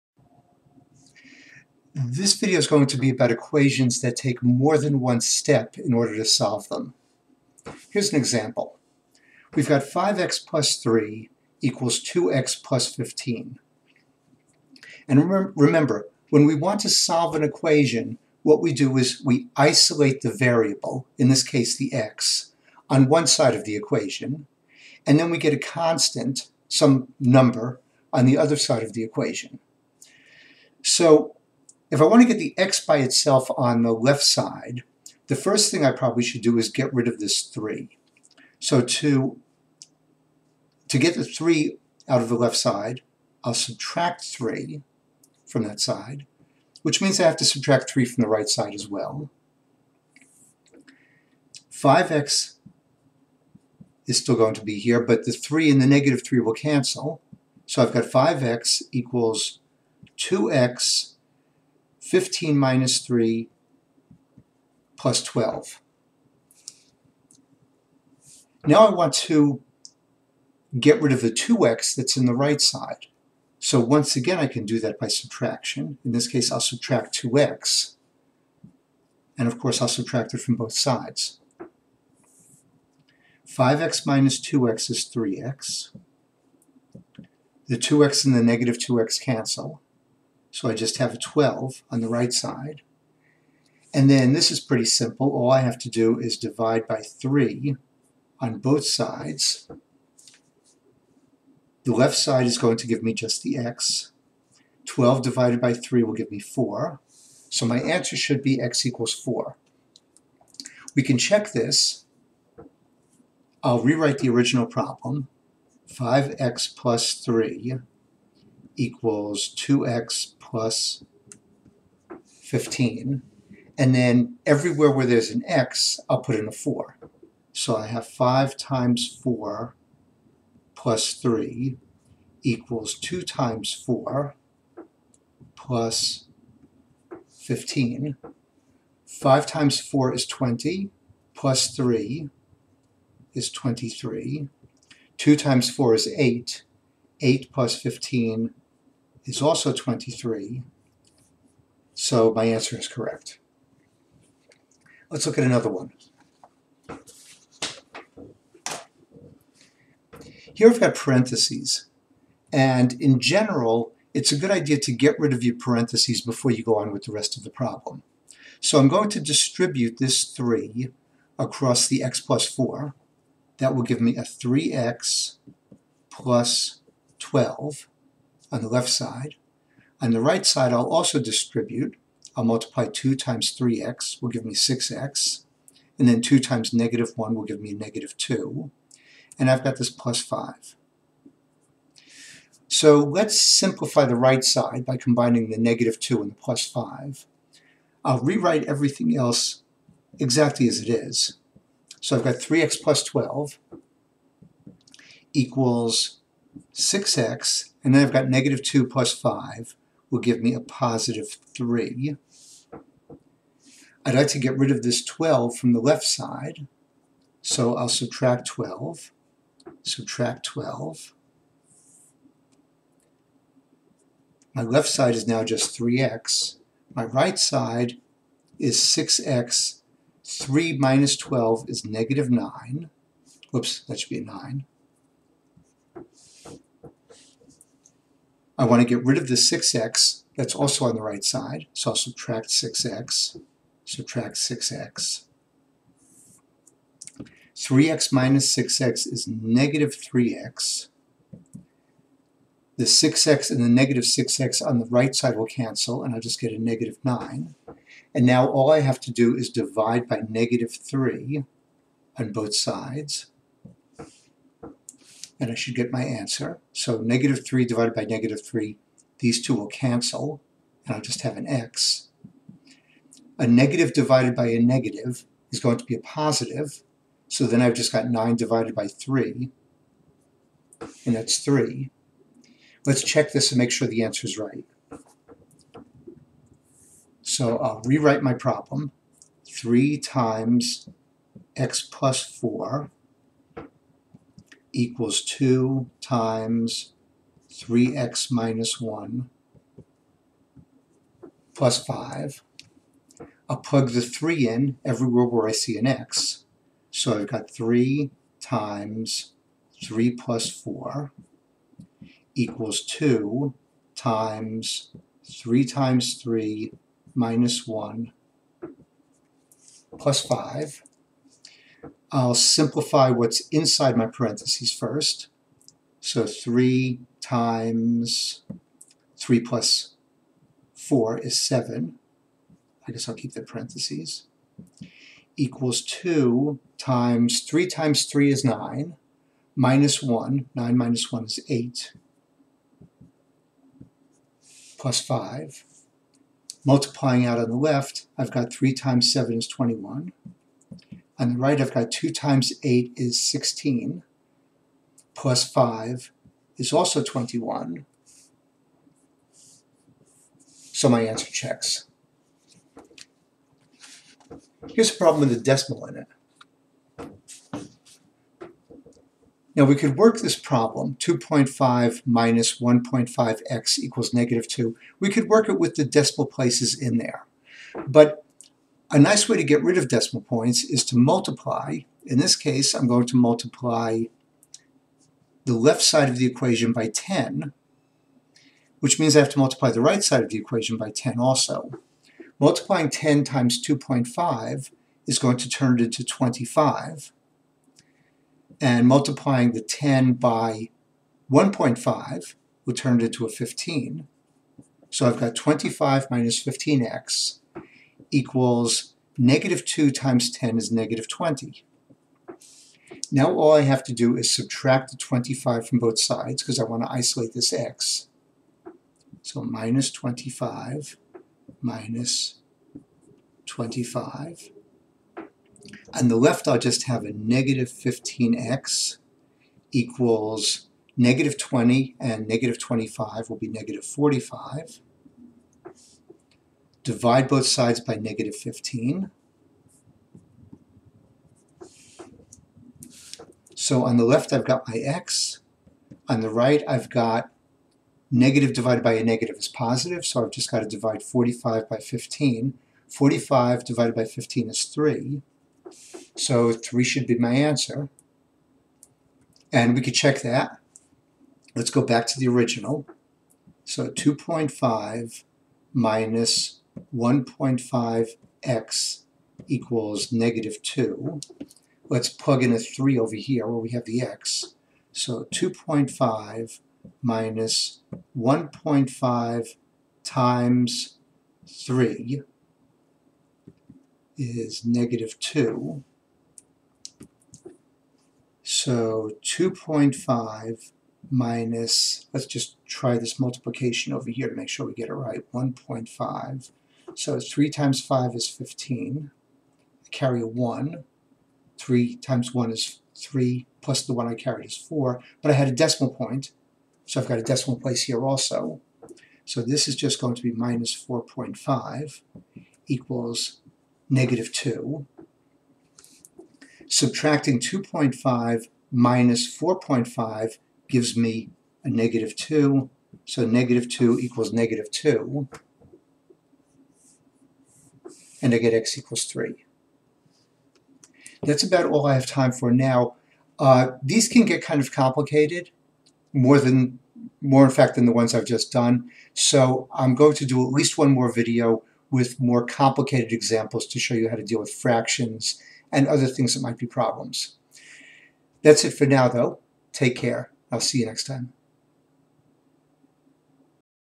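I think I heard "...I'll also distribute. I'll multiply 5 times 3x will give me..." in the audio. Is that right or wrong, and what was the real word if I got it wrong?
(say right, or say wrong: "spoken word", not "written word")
wrong: "2", not "5".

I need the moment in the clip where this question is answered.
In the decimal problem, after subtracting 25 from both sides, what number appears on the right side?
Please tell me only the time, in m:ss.
7:13.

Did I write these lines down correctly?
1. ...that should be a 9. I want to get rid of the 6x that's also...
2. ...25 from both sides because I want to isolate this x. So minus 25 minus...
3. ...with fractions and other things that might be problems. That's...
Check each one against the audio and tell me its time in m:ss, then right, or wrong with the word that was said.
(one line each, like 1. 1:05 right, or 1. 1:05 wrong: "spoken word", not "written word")
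1. 3:53 right
2. 6:54 right
3. 9:04 right.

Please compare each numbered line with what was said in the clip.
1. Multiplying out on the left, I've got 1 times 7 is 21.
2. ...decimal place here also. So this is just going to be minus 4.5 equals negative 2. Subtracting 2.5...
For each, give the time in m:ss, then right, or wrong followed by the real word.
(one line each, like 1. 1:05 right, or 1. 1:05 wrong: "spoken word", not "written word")
1. 5:46 wrong: "3", not "1"
2. 8:27 right.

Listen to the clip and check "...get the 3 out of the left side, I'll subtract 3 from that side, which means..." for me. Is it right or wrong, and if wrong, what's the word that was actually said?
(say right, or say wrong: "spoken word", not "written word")
right.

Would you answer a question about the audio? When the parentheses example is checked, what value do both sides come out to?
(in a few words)
21.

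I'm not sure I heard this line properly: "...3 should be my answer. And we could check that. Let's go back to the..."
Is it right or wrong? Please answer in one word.
right.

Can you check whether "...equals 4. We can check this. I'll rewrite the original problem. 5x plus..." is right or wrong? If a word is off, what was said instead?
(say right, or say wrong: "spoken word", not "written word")
right.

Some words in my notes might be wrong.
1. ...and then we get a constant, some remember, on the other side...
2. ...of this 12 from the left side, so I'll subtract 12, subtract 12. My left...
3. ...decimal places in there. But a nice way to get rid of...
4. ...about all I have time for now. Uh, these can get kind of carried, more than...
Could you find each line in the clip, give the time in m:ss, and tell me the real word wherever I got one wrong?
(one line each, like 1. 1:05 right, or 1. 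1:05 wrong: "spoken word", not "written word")
1. 0:25 wrong: "number", not "remember"
2. 3:34 right
3. 6:15 right
4. 8:51 wrong: "complicated", not "carried".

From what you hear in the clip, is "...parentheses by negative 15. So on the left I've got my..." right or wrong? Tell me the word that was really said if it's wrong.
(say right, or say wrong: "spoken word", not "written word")
wrong: "sides", not "parentheses".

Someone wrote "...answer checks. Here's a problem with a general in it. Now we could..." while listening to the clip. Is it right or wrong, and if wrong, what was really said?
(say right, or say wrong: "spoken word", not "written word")
wrong: "decimal", not "general".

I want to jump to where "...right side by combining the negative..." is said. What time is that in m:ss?
3:14.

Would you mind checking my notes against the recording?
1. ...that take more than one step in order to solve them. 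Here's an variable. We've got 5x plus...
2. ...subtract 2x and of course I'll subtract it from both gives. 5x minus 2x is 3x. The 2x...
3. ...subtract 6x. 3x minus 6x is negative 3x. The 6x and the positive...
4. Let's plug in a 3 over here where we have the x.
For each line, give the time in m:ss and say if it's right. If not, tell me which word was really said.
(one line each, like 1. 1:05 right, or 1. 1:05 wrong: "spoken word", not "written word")
1. 0:03 wrong: "example", not "variable"
2. 1:16 wrong: "sides", not "gives"
3. 4:03 wrong: "negative", not "positive"
4. 7:51 right.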